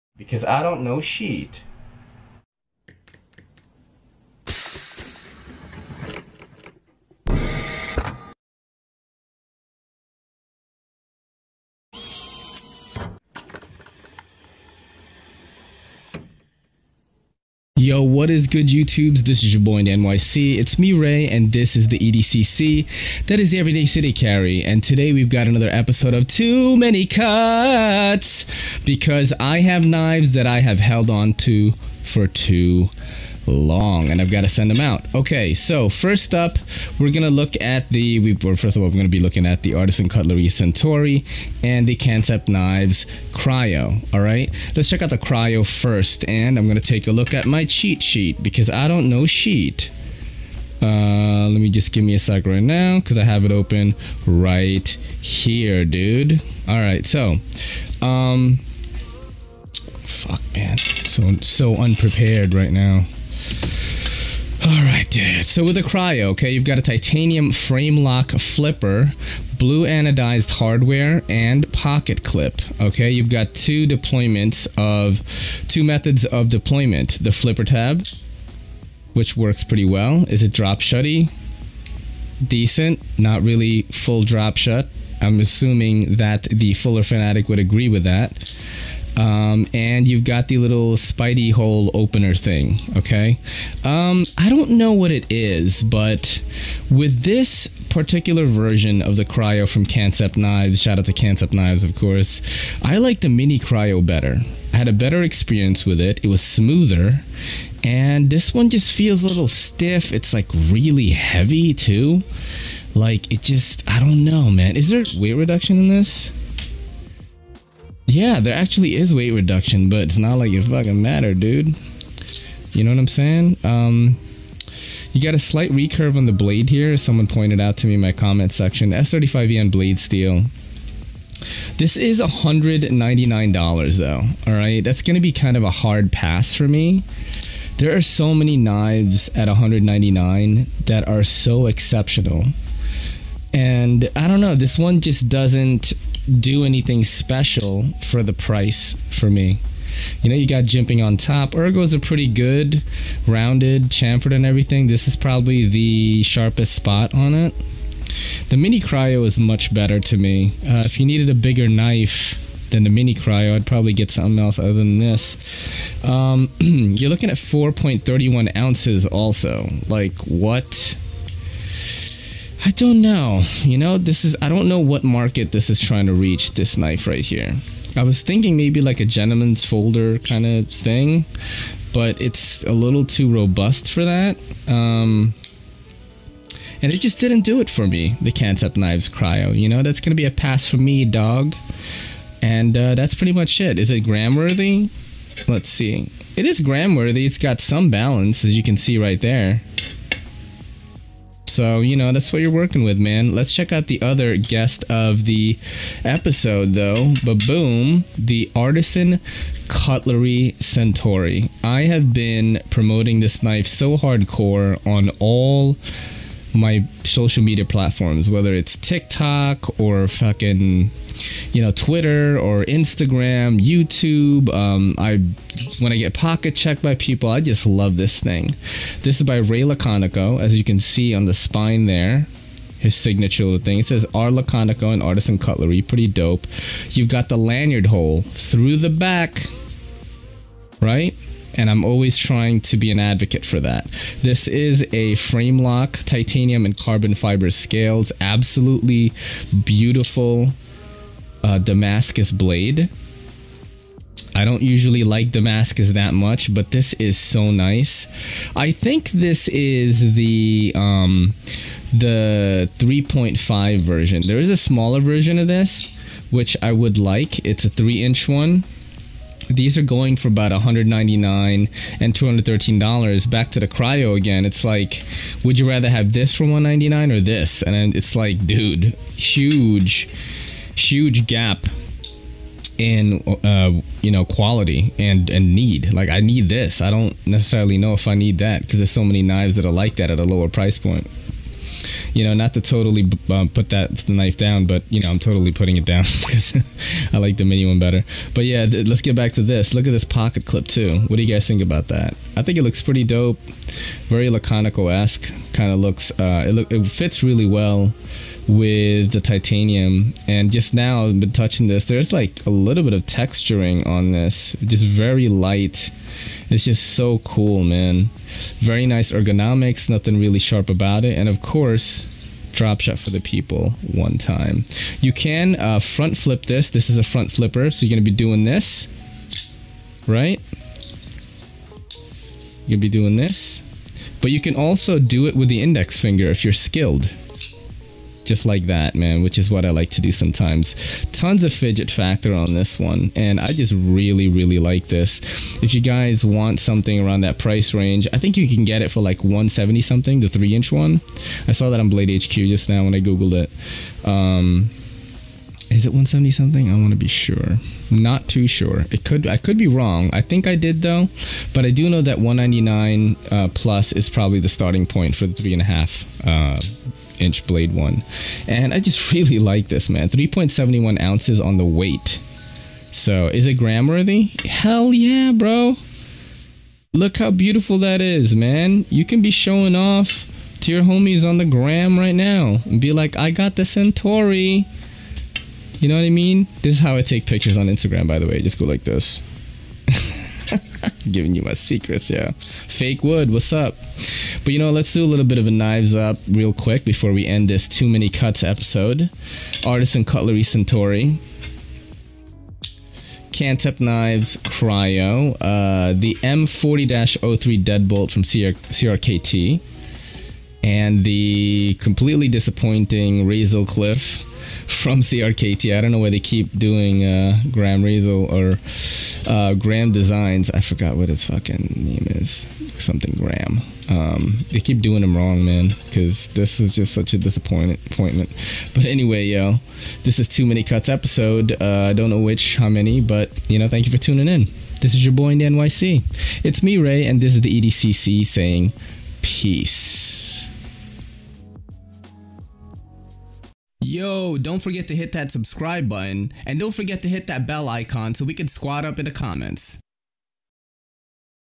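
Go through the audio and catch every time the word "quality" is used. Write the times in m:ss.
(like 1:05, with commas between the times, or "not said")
4:44.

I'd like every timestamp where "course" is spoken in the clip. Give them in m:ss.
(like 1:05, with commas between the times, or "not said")
1:41, 5:21.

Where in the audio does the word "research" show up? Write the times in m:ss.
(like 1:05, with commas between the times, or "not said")
not said.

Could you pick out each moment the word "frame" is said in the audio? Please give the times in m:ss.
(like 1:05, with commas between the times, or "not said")
1:07, 4:05.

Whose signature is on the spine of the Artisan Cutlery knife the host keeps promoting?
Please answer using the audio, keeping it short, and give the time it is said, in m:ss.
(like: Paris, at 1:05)
Ray Laconico, at 3:49.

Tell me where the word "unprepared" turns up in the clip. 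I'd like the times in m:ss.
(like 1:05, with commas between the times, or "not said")
1:01.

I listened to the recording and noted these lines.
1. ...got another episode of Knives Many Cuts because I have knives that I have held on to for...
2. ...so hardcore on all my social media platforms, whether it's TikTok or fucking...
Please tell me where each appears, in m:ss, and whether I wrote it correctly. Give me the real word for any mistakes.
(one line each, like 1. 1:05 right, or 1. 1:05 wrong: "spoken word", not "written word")
1. 0:25 wrong: "Too", not "Knives"
2. 3:33 right.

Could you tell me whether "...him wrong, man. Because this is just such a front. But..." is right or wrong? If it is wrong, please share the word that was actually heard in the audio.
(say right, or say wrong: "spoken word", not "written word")
wrong: "disappointment", not "front".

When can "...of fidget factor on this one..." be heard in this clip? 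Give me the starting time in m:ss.
5:41.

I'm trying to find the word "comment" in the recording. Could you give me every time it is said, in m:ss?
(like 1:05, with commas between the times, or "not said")
2:08, 7:29.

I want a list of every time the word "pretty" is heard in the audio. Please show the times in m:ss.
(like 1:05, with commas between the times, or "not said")
1:19, 2:31, 3:13, 3:55, 5:02.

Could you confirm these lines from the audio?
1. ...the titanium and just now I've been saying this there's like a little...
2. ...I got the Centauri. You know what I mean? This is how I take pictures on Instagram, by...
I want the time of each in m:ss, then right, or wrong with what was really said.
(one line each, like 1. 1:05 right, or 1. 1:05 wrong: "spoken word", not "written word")
1. 5:09 wrong: "touching", not "saying"
2. 6:23 right.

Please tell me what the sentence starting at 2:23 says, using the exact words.
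And I don't know, this one just doesn't do anything special for the price for me.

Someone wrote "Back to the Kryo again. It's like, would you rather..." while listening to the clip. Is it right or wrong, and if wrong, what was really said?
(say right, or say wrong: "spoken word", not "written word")
right.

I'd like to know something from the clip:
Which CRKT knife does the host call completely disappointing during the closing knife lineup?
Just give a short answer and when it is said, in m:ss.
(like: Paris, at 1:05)
Razel Cliff, at 6:53.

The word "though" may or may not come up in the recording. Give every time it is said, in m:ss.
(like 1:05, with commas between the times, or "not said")
2:13, 3:26, 6:00.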